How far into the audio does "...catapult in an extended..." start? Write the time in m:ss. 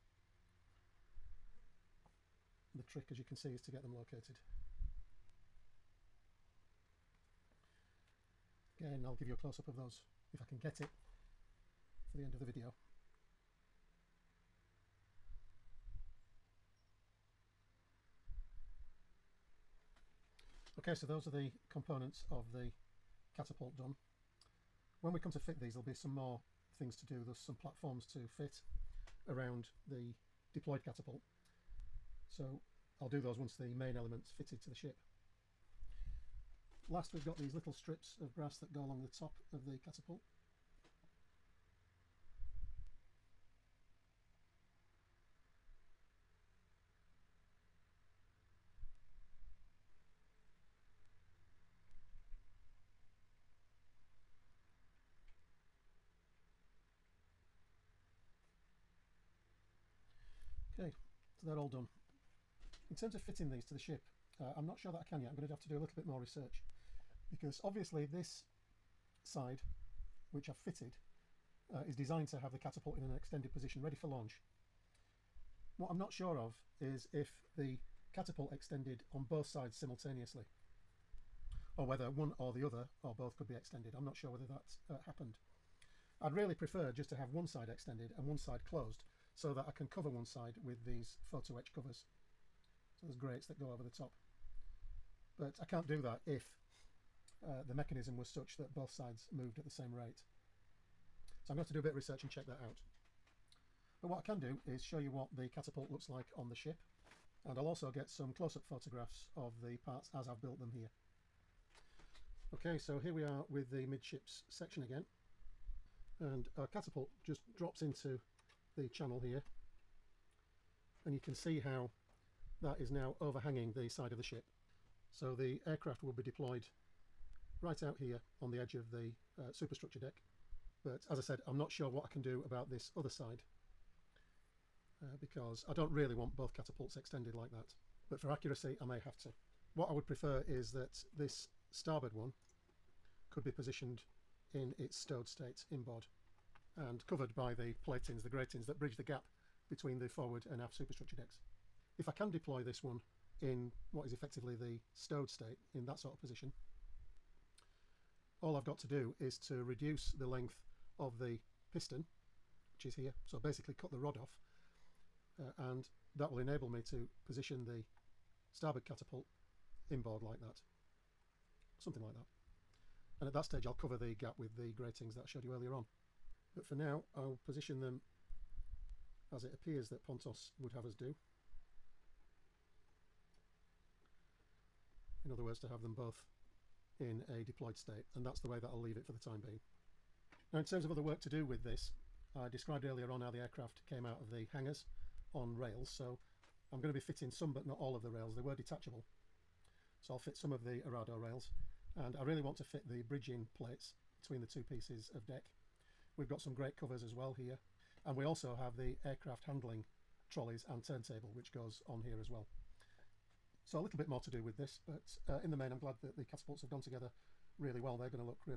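1:12.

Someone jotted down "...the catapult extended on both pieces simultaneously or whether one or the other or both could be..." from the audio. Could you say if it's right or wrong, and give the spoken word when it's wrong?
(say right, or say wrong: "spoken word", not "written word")
wrong: "sides", not "pieces".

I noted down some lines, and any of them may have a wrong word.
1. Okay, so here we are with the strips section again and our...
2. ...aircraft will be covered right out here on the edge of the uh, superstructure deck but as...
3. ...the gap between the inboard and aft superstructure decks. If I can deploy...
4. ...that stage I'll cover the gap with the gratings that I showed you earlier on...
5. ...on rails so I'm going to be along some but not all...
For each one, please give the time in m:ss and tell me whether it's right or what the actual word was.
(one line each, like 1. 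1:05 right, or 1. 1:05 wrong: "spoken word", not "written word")
1. 1:52 wrong: "midships", not "strips"
2. 2:05 wrong: "deployed", not "covered"
3. 2:28 wrong: "forward", not "inboard"
4. 2:53 right
5. 3:15 wrong: "fitting", not "along".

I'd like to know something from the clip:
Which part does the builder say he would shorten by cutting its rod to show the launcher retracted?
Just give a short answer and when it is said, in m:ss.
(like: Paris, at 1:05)
The piston, at 2:41.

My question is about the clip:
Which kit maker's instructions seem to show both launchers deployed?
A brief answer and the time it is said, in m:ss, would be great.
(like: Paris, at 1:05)
Pontos, at 3:00.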